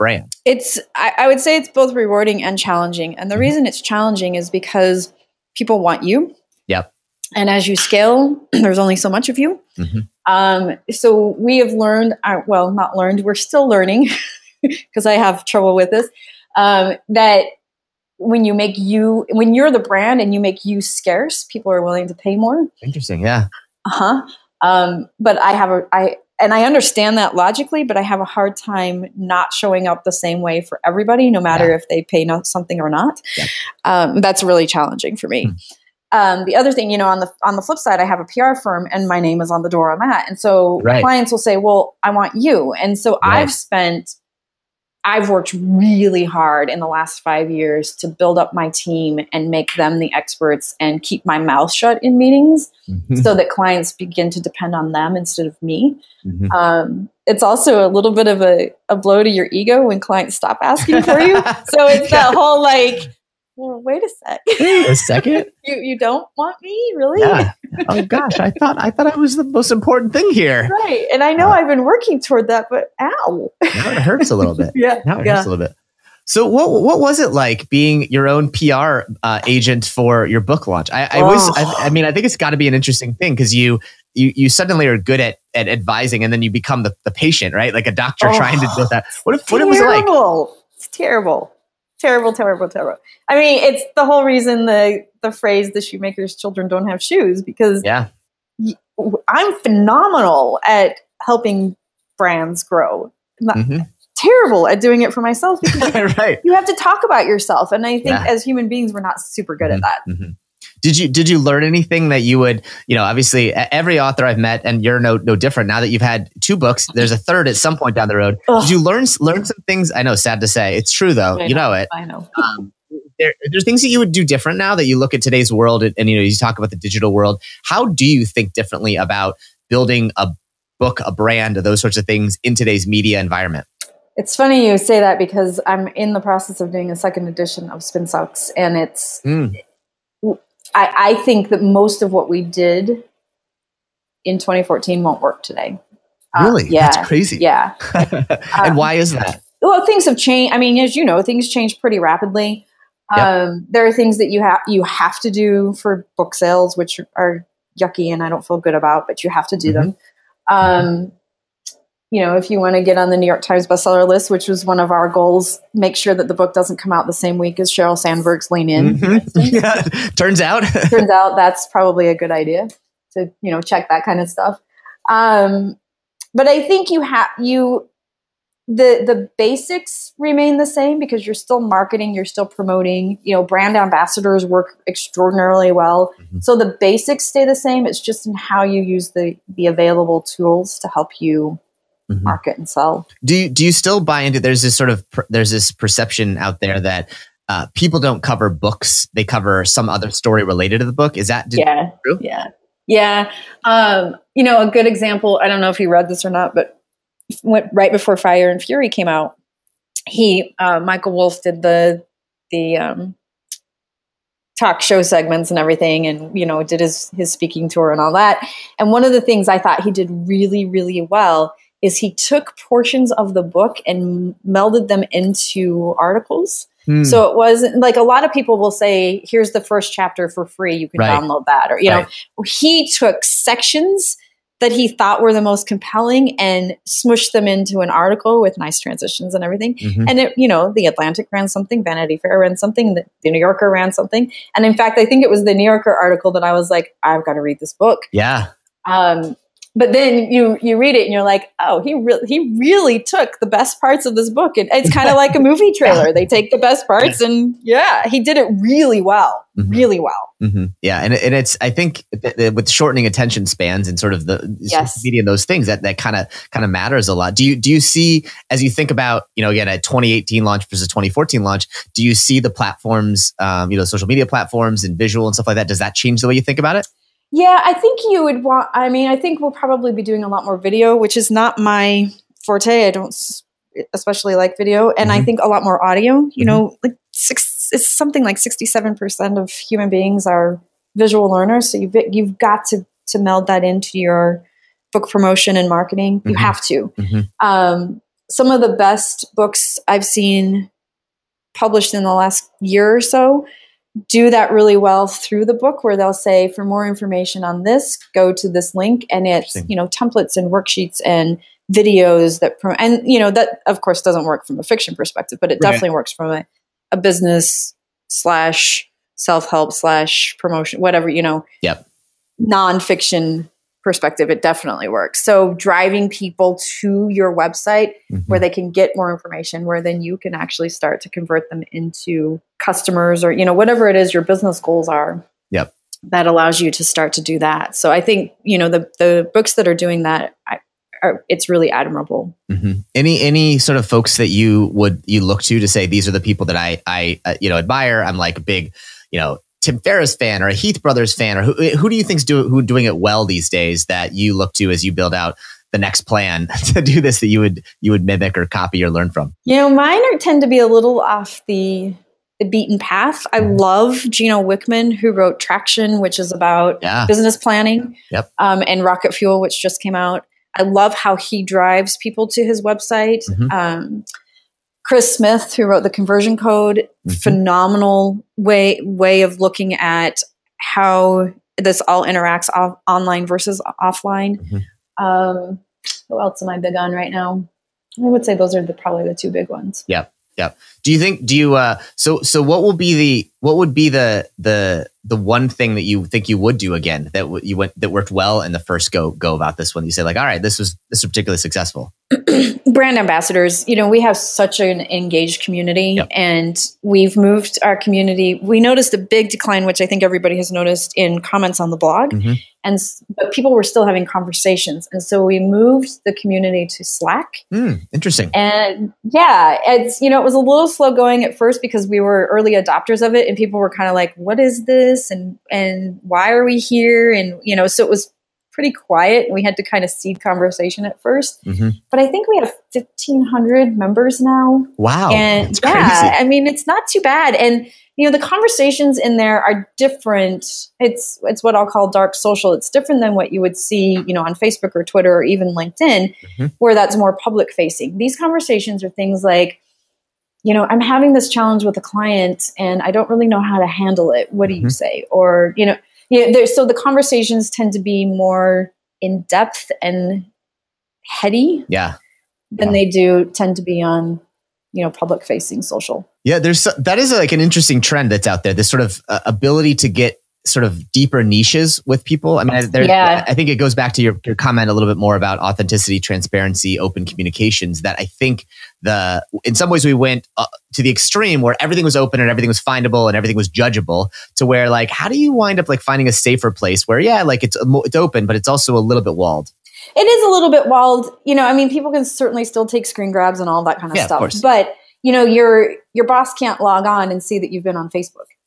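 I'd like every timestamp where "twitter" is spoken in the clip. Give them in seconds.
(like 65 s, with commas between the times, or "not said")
444 s.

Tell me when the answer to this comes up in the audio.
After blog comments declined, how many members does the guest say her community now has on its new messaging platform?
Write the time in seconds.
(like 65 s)
432 s.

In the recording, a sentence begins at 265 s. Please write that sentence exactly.
media and those things that that kind of kind of matters a lot.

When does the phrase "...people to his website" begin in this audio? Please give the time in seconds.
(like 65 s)
371 s.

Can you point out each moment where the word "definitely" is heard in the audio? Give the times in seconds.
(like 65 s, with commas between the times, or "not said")
315 s, 324 s.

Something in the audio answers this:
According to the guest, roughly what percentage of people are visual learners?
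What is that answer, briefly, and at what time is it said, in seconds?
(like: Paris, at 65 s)
67%, at 288 s.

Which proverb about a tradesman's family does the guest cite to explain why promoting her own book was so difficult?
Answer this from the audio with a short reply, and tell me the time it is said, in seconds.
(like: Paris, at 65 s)
The shoemaker's children don't have shoes, at 95 s.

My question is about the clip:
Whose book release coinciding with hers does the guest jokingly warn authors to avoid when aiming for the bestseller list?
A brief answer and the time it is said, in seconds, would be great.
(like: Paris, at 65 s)
Sheryl Sandberg, at 167 s.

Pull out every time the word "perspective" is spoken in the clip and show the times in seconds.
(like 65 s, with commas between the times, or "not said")
314 s, 323 s.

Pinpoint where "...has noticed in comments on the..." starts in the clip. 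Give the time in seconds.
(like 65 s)
410 s.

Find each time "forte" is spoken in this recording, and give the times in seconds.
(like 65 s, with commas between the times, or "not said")
282 s.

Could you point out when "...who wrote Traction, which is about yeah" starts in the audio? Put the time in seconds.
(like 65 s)
364 s.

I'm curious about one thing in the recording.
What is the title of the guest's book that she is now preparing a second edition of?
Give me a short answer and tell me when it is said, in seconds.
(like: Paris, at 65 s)
Spin Sucks, at 137 s.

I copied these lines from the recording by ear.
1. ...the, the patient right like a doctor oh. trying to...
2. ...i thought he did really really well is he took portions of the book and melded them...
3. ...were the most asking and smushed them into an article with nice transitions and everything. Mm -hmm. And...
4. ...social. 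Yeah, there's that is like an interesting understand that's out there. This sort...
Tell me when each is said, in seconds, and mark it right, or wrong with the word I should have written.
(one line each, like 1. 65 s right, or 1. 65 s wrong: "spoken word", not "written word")
1. 86 s right
2. 219 s right
3. 235 s wrong: "compelling", not "asking"
4. 465 s wrong: "trend", not "understand".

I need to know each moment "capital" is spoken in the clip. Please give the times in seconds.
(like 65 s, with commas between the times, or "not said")
not said.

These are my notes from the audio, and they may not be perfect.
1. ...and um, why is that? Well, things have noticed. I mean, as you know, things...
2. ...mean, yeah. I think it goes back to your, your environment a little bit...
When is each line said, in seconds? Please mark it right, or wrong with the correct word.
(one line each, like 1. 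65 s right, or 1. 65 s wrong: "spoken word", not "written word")
1. 147 s wrong: "changed", not "noticed"
2. 472 s wrong: "comment", not "environment".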